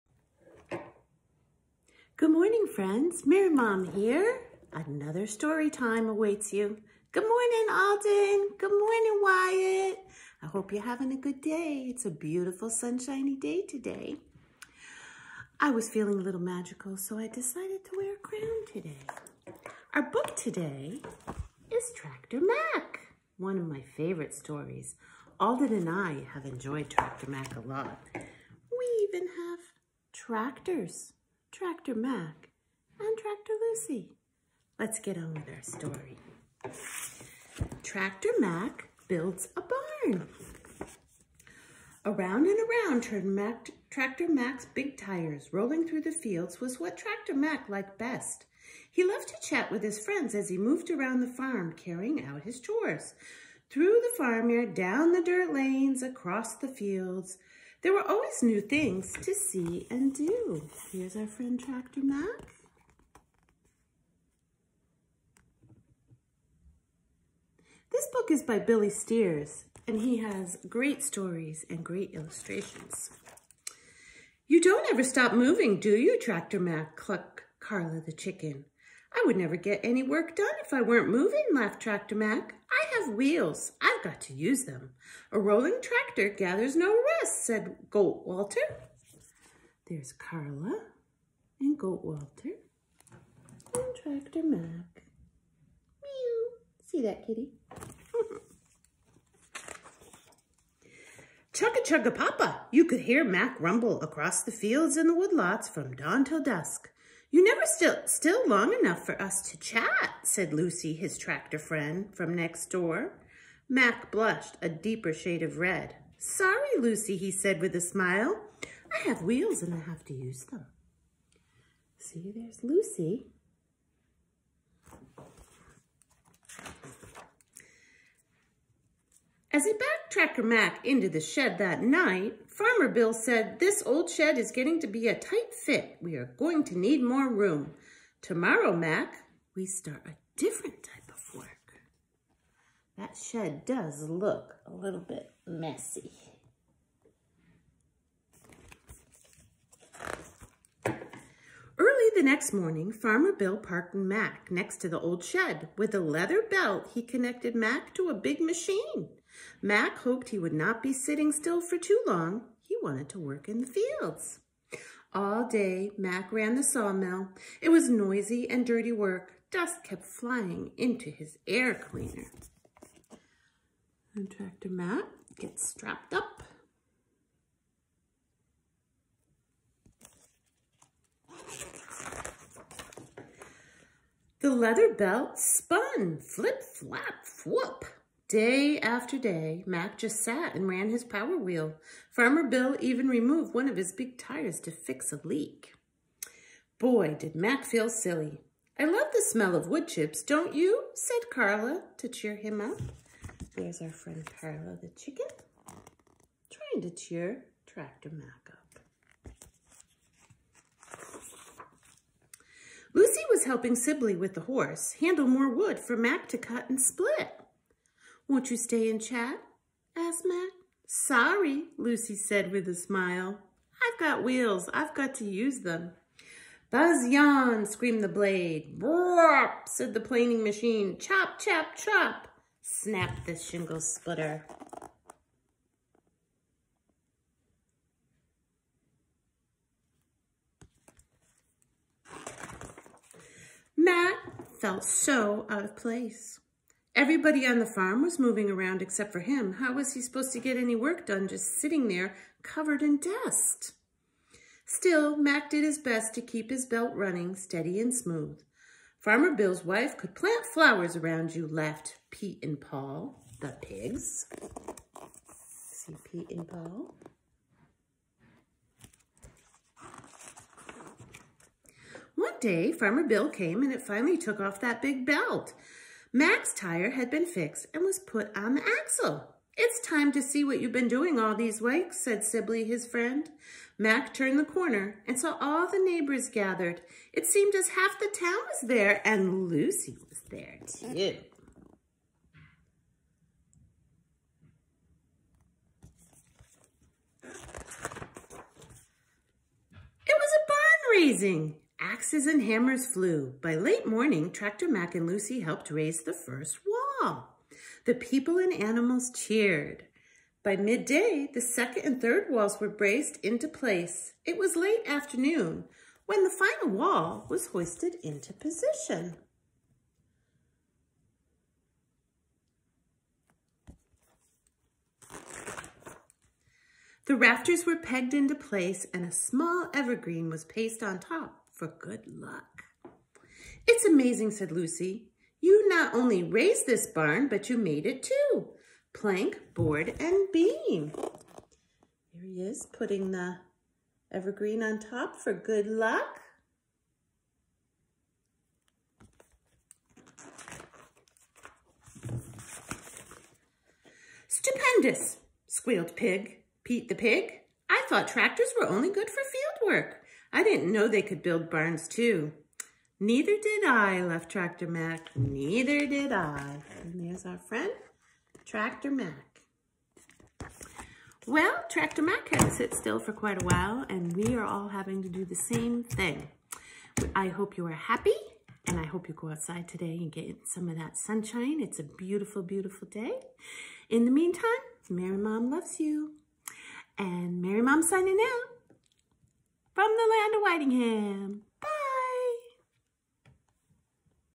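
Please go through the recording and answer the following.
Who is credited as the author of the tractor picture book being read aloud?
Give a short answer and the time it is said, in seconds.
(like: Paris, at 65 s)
Billy Steers, at 68 s.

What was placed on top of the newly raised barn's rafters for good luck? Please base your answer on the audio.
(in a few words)
small evergreen.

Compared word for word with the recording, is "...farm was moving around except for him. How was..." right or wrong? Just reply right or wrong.
right.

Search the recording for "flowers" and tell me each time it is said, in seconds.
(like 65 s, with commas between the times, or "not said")
260 s.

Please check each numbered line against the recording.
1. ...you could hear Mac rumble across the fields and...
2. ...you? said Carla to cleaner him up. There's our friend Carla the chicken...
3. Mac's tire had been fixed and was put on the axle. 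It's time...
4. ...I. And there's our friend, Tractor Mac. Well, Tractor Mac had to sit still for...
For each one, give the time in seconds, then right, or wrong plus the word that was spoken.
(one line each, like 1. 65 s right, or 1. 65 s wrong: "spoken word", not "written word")
1. 102 s right
2. 200 s wrong: "cheer", not "cleaner"
3. 276 s right
4. 366 s right.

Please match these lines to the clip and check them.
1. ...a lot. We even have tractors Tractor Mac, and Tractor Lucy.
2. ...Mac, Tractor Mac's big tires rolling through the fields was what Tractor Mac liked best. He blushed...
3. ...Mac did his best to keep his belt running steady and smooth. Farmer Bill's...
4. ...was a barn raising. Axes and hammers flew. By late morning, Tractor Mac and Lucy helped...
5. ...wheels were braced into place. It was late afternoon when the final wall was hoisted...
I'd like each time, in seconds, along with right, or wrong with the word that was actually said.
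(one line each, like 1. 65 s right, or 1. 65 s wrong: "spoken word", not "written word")
1. 27 s right
2. 43 s wrong: "loved", not "blushed"
3. 255 s right
4. 297 s right
5. 312 s wrong: "walls", not "wheels".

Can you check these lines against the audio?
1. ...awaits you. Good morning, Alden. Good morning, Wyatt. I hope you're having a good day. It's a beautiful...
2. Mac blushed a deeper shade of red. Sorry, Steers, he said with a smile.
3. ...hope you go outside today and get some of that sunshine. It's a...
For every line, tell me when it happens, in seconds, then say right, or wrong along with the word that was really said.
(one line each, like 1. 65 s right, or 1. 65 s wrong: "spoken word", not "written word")
1. 6 s right
2. 113 s wrong: "Lucy", not "Steers"
3. 378 s right.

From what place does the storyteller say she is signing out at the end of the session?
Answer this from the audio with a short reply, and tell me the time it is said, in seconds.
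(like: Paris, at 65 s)
Whitingham, at 390 s.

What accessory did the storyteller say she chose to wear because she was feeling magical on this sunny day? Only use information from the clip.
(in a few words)
crown.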